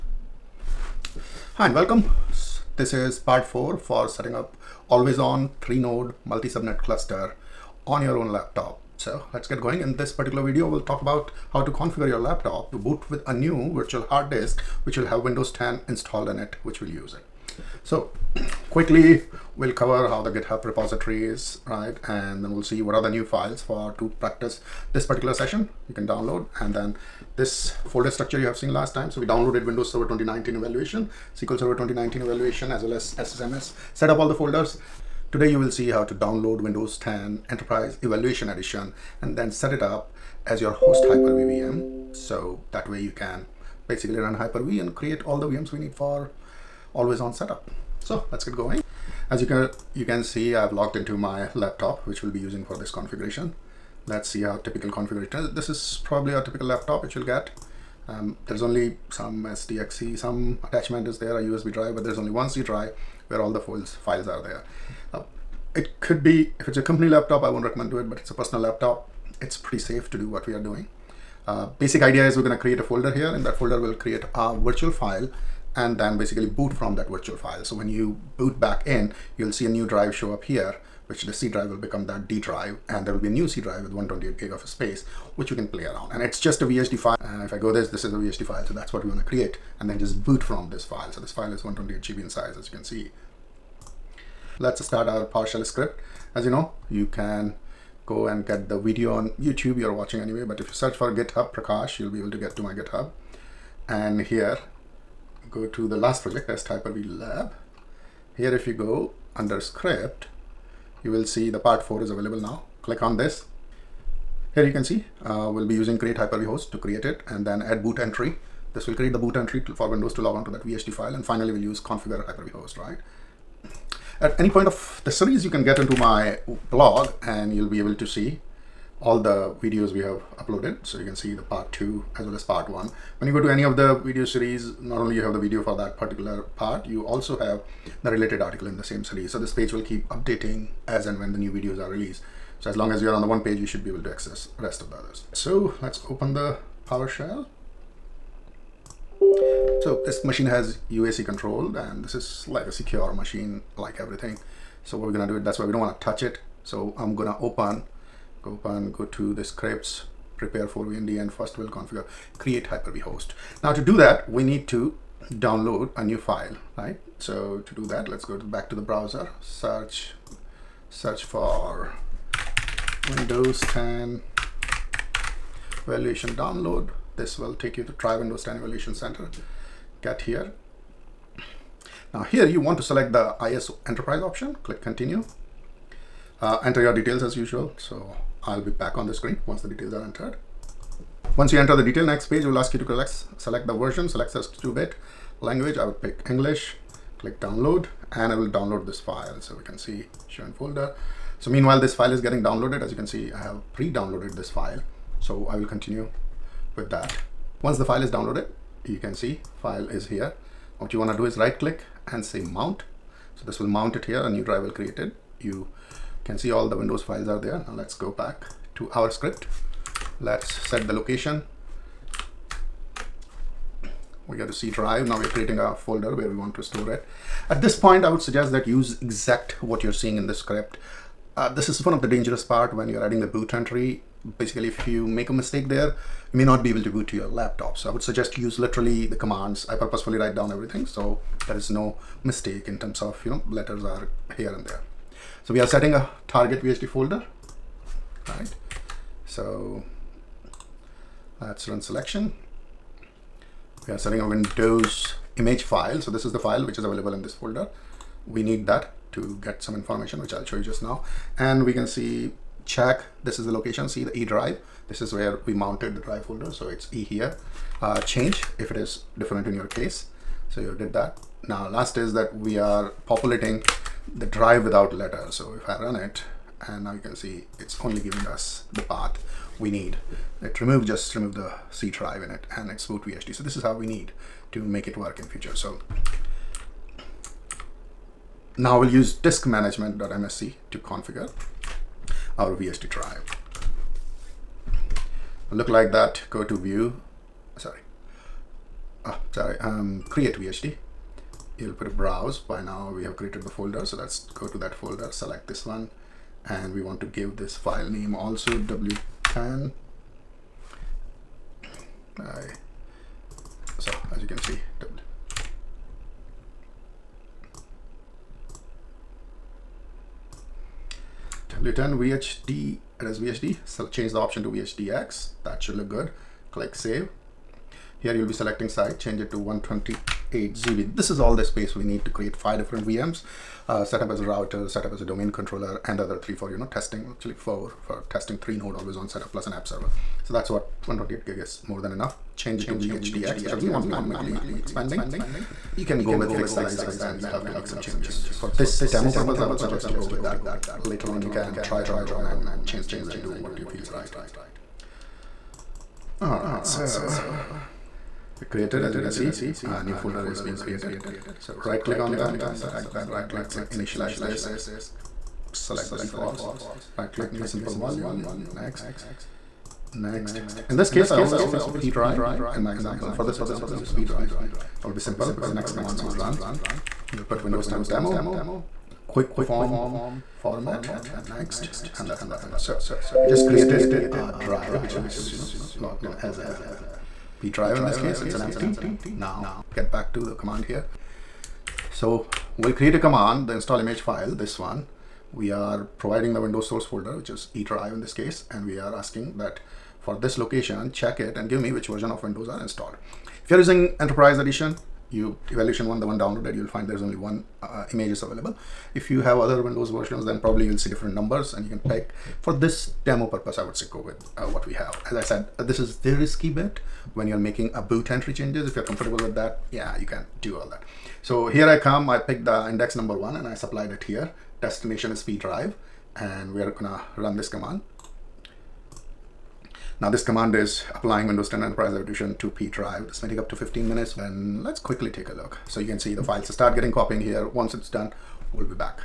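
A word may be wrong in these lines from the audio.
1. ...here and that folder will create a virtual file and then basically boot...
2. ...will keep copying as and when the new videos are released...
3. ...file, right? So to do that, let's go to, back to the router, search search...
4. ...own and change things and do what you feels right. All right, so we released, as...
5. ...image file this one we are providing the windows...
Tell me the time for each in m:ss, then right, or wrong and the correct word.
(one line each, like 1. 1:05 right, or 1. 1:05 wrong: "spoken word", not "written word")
1. 1:13 right
2. 2:19 wrong: "updating", not "copying"
3. 2:46 wrong: "browser", not "router"
4. 5:52 wrong: "created", not "released"
5. 6:33 right.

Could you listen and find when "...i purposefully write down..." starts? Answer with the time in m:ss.
3:59.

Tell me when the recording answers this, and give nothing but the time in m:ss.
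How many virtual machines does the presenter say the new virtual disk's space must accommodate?
5:32.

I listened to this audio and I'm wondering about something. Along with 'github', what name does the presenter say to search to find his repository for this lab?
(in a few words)
Prakash.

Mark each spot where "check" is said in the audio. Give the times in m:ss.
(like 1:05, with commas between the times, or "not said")
4:22, 6:40.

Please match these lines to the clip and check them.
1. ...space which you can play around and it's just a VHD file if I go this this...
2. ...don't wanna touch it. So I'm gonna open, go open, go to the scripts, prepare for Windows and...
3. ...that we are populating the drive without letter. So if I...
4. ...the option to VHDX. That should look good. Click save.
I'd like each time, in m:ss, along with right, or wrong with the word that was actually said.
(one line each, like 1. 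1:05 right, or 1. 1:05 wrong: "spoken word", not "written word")
1. 1:24 right
2. 2:35 wrong: "VND", not "Windows"
3. 4:32 right
4. 5:24 right.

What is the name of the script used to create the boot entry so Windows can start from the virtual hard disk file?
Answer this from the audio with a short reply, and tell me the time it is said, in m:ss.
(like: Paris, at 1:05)
add boot entry, at 1:57.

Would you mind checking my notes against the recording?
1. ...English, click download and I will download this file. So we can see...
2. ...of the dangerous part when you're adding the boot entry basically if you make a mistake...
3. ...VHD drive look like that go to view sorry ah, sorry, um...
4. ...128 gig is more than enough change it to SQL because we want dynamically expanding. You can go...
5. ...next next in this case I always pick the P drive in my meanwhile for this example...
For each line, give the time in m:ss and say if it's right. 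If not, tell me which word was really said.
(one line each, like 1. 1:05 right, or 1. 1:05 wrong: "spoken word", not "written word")
1. 3:16 right
2. 3:51 right
3. 4:52 right
4. 5:40 wrong: "VHDX", not "SQL"
5. 6:08 wrong: "example", not "meanwhile".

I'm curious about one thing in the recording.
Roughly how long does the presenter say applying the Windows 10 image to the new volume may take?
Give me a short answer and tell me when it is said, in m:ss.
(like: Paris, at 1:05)
15 minutes, at 7:13.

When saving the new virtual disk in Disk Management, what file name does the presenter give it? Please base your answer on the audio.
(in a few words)
w10.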